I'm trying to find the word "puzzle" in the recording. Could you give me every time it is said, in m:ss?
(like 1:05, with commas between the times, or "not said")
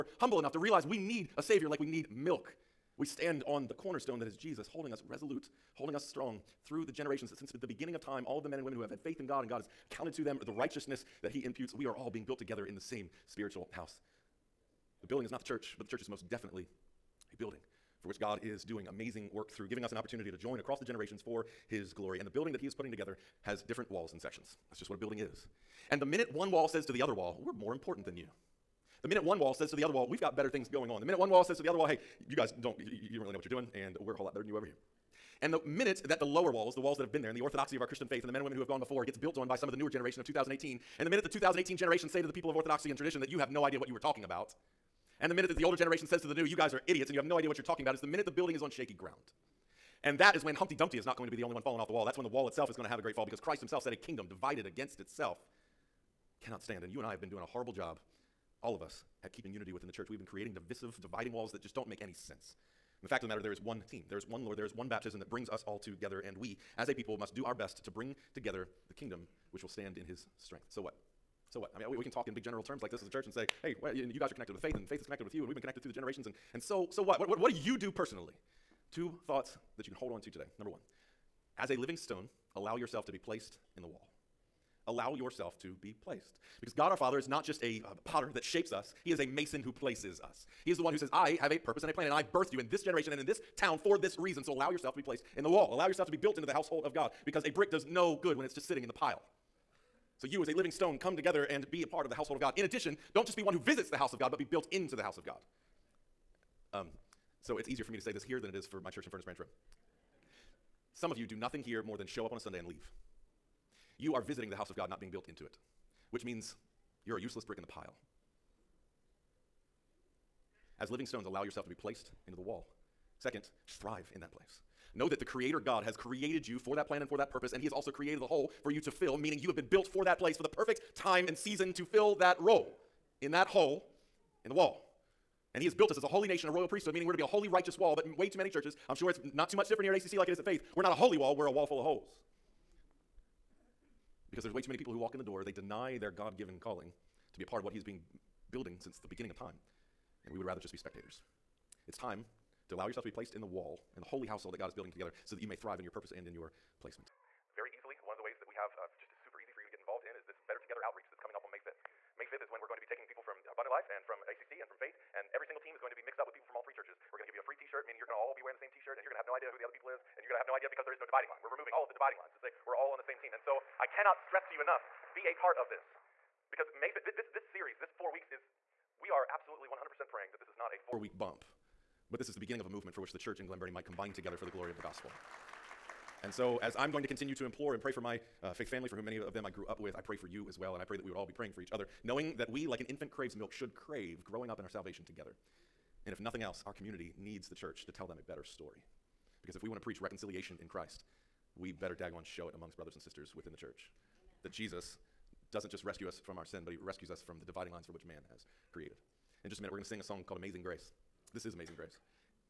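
not said.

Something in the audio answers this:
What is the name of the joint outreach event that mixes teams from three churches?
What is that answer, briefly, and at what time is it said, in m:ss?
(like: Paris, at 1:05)
Better Together, at 2:40.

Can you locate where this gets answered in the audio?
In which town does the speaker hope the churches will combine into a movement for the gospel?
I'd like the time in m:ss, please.
3:03.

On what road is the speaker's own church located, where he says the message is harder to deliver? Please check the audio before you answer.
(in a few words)
Furnace Branch Road.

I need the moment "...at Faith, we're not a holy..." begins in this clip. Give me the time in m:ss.
2:20.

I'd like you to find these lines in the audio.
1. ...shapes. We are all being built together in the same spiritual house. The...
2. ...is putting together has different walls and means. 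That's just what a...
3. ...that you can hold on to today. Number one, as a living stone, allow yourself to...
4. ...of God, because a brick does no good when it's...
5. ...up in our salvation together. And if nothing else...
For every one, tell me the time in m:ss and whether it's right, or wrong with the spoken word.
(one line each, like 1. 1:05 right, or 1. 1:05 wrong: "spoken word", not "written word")
1. 0:11 wrong: "imputes", not "shapes"
2. 0:22 wrong: "sections", not "means"
3. 1:19 right
4. 1:36 right
5. 3:14 right.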